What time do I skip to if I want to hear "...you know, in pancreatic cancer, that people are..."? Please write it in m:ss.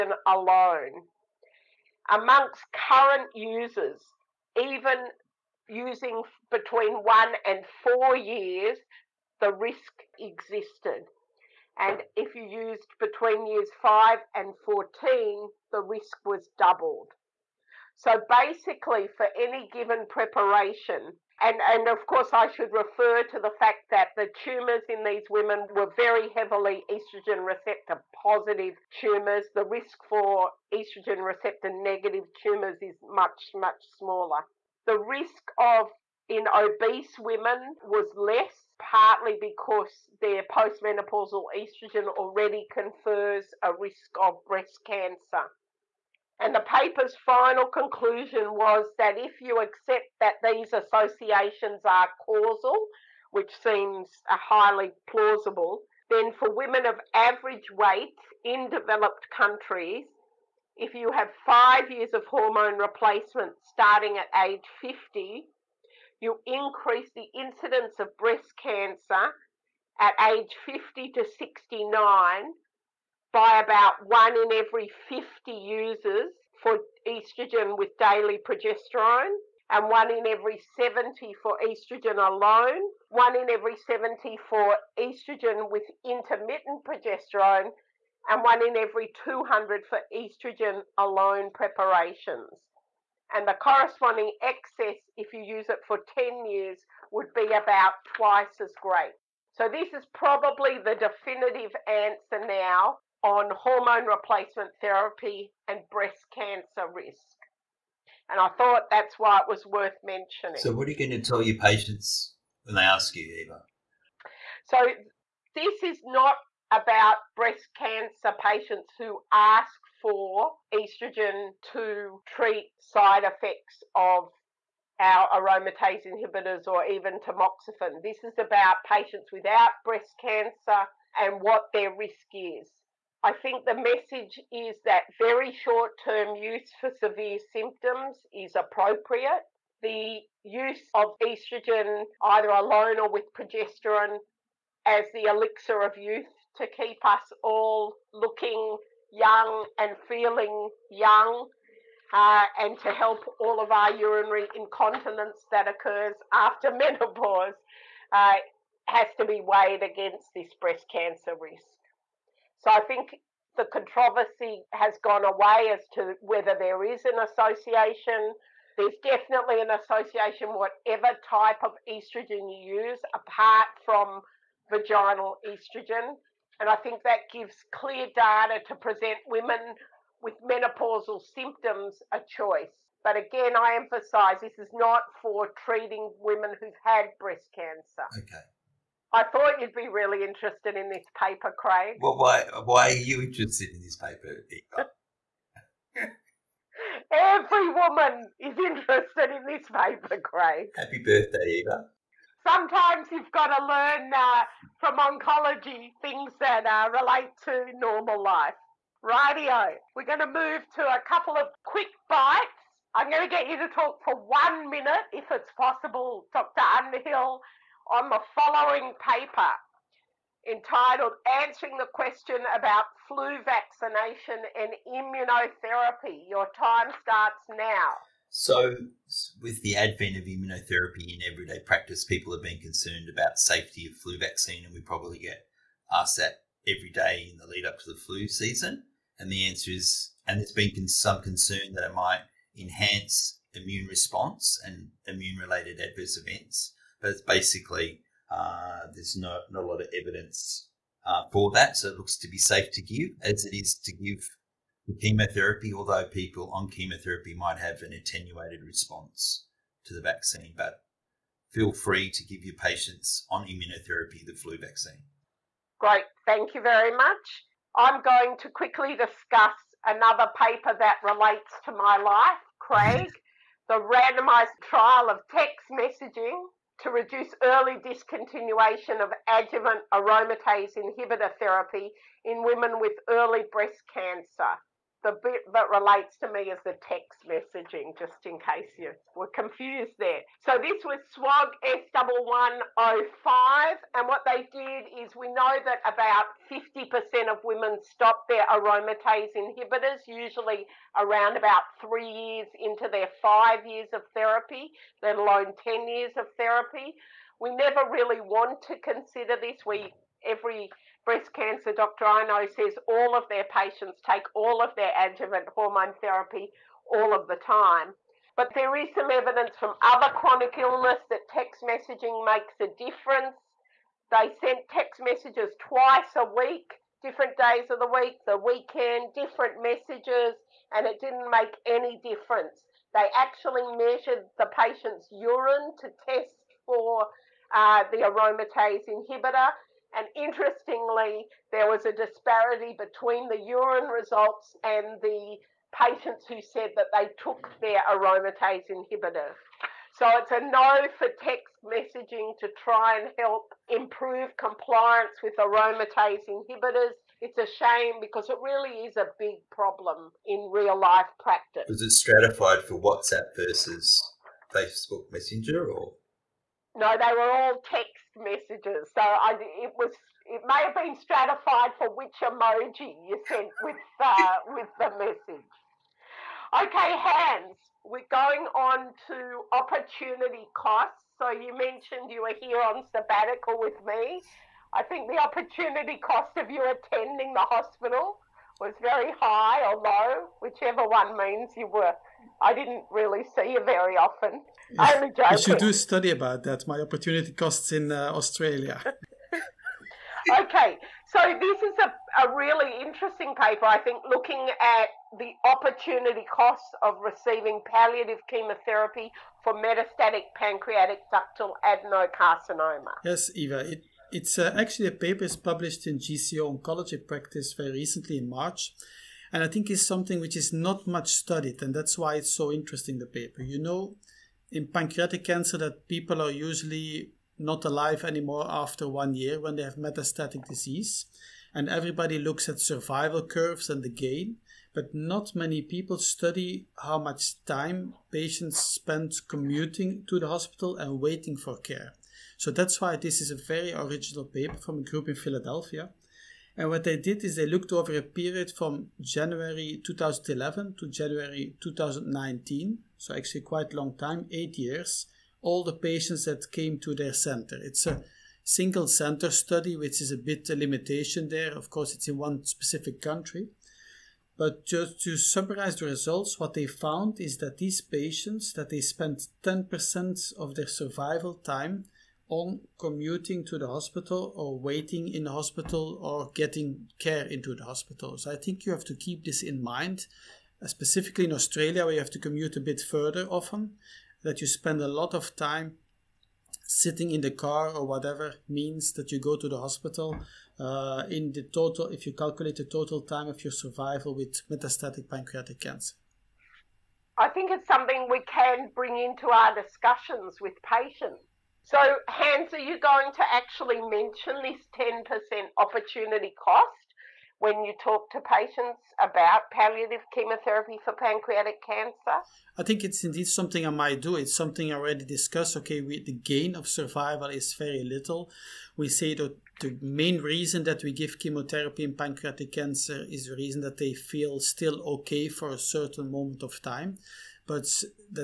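7:03.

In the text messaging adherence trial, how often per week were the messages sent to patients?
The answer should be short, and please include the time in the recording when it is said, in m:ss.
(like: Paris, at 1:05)
Twice a week, at 5:25.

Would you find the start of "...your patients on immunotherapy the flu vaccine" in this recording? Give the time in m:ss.
4:22.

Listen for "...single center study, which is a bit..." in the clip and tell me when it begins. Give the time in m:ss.
7:38.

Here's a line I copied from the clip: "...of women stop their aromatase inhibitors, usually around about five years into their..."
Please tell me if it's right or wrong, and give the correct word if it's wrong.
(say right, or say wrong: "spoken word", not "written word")
wrong: "three", not "five".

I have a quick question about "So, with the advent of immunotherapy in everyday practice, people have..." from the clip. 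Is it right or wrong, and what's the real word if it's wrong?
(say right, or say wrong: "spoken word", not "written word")
right.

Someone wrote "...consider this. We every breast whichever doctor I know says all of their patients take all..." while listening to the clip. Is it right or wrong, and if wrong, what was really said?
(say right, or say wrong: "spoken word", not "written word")
wrong: "cancer", not "whichever".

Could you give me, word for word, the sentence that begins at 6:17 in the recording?
We're going on to opportunity costs.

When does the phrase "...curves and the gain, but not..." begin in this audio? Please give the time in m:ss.
7:13.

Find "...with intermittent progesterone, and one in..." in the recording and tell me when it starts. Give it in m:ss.
1:25.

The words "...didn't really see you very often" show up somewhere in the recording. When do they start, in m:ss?
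6:32.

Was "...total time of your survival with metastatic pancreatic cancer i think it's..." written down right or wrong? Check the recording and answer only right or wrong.
right.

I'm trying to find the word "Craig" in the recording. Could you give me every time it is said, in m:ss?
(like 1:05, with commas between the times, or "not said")
3:11, 3:20, 4:32.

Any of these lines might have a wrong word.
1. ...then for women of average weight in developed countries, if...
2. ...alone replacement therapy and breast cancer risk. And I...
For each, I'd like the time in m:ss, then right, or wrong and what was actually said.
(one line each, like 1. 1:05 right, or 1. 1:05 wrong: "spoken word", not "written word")
1. 0:56 right
2. 1:43 wrong: "hormone", not "alone".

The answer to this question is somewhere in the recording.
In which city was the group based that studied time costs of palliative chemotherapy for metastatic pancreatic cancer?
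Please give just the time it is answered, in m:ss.
7:25.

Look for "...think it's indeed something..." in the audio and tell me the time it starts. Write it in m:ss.
8:32.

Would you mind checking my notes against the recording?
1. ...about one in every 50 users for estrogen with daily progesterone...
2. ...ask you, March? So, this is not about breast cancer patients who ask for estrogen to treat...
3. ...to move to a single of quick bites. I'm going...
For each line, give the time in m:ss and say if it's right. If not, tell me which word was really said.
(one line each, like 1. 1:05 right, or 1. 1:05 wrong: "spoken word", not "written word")
1. 1:13 right
2. 1:52 wrong: "Eva", not "March"
3. 3:30 wrong: "couple", not "single".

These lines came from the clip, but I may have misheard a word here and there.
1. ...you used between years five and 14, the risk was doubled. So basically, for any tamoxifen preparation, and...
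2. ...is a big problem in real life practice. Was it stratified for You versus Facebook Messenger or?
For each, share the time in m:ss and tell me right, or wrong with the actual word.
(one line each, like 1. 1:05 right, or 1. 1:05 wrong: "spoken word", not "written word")
1. 0:12 wrong: "given", not "tamoxifen"
2. 5:58 wrong: "WhatsApp", not "You".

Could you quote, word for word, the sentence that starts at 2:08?
This is about patients without breast cancer and what their risk is.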